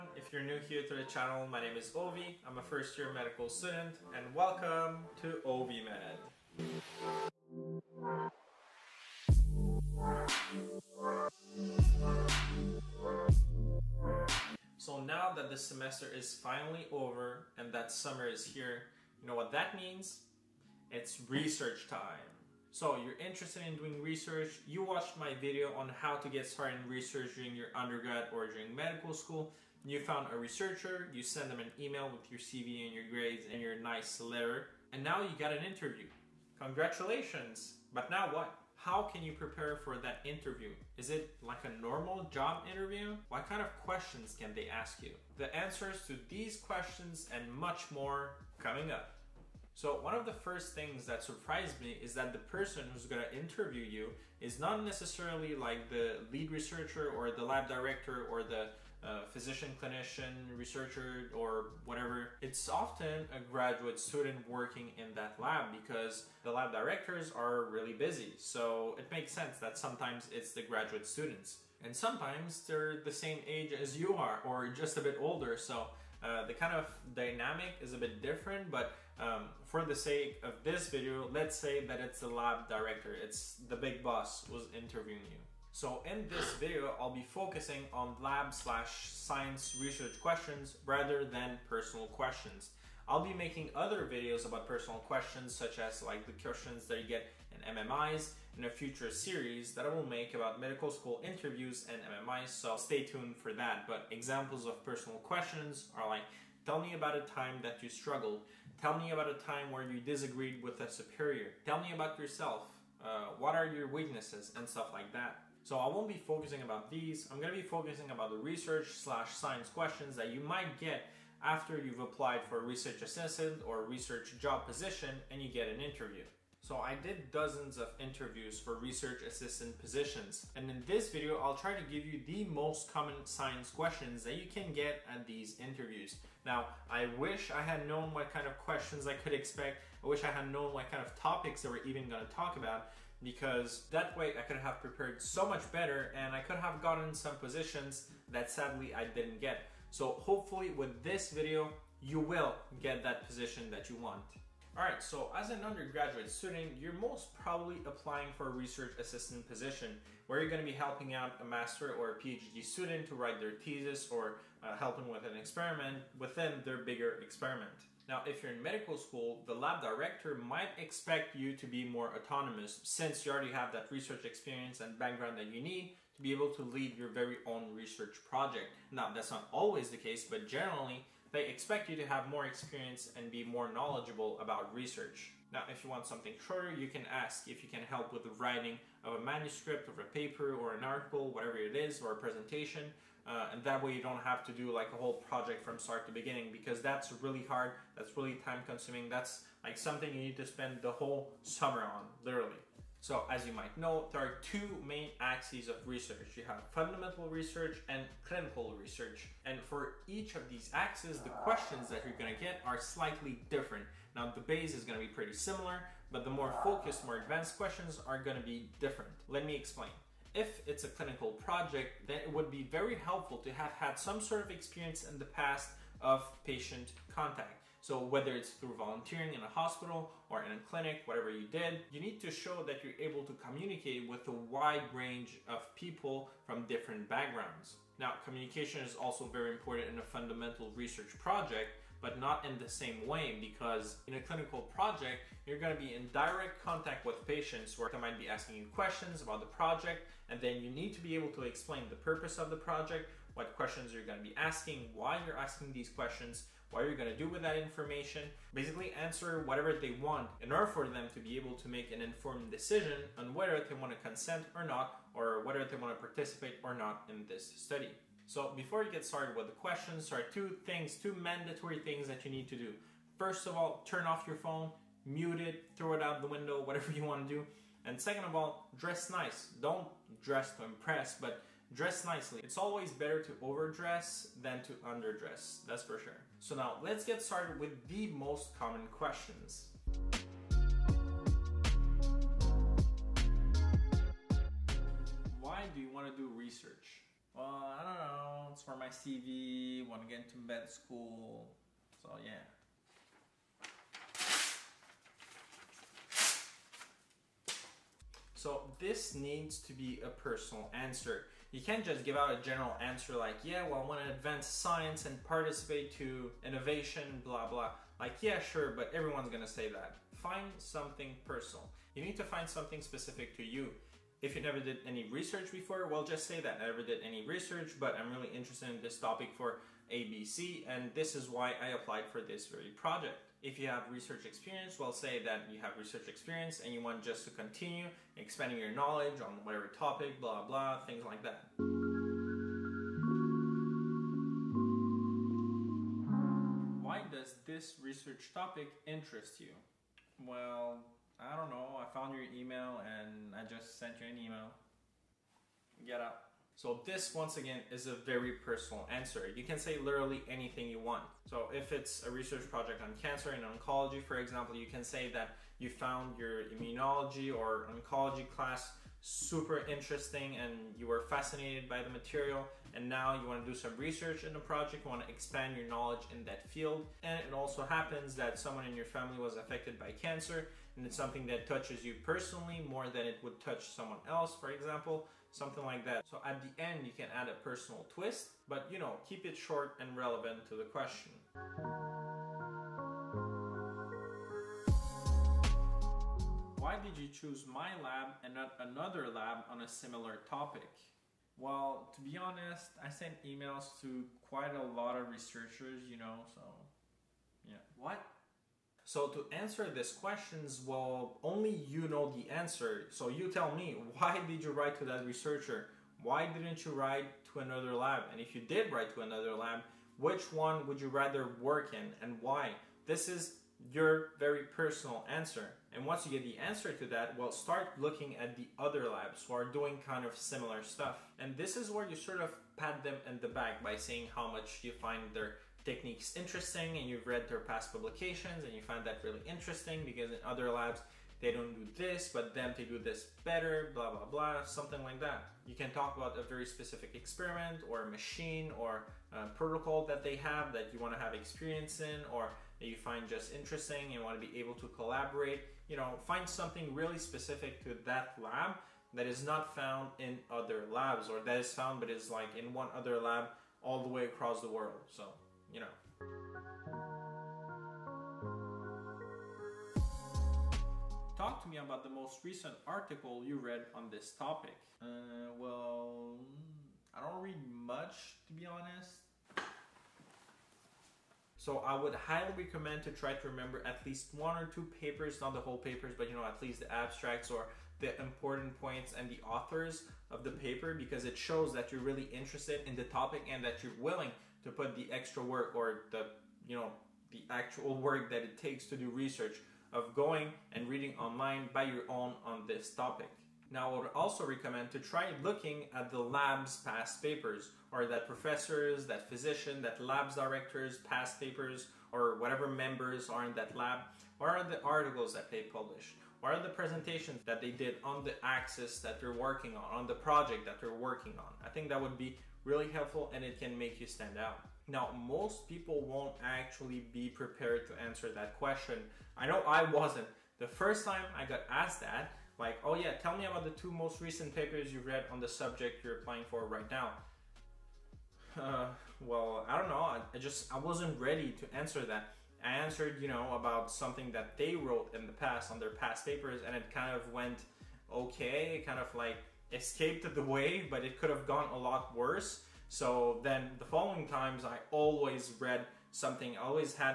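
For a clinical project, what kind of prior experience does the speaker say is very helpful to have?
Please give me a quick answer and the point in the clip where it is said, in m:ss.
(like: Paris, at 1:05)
Patient contact, at 3:46.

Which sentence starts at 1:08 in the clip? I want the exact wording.
So it makes sense that sometimes it's the graduate students.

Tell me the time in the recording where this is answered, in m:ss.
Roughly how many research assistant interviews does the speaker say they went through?
2:07.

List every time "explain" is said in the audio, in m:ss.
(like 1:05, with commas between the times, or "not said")
3:39, 4:11.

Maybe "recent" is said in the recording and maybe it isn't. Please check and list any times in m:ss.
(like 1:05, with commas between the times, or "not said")
7:52, 8:54.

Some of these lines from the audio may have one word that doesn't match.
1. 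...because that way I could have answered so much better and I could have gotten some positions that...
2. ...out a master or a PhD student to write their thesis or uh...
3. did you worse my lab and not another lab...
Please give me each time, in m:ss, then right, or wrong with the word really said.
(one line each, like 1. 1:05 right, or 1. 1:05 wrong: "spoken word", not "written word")
1. 2:23 wrong: "prepared", not "answered"
2. 2:41 right
3. 6:36 wrong: "choose", not "worse".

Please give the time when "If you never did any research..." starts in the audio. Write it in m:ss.
5:24.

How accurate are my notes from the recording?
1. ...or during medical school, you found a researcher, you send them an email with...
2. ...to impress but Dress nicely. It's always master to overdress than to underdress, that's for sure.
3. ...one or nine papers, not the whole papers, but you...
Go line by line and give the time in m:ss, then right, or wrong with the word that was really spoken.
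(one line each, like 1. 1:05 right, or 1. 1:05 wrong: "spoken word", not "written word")
1. 0:28 right
2. 4:40 wrong: "better", not "master"
3. 8:04 wrong: "two", not "nine".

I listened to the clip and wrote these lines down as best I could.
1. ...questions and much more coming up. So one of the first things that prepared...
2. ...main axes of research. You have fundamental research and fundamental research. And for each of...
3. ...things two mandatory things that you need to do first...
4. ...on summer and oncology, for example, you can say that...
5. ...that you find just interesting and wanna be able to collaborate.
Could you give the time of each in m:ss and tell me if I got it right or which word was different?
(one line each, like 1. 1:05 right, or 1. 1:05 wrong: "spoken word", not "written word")
1. 0:46 wrong: "surprised", not "prepared"
2. 3:24 wrong: "clinical", not "fundamental"
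3. 4:30 right
4. 6:02 wrong: "cancer", not "summer"
5. 7:32 right.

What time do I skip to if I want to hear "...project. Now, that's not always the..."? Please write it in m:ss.
2:58.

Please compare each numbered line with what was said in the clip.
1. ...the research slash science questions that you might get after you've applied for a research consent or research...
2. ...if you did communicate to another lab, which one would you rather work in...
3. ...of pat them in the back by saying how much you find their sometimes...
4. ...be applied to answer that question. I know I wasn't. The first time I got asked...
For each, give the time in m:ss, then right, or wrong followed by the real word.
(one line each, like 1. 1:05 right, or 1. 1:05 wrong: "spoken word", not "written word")
1. 1:58 wrong: "assistant", not "consent"
2. 6:58 wrong: "write", not "communicate"
3. 7:12 wrong: "techniques", not "sometimes"
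4. 8:46 wrong: "prepared", not "applied".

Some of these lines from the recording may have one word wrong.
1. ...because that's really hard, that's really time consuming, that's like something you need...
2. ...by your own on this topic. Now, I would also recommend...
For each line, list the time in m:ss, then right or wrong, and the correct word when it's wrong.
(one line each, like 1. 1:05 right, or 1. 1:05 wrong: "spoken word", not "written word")
1. 3:16 right
2. 8:21 right.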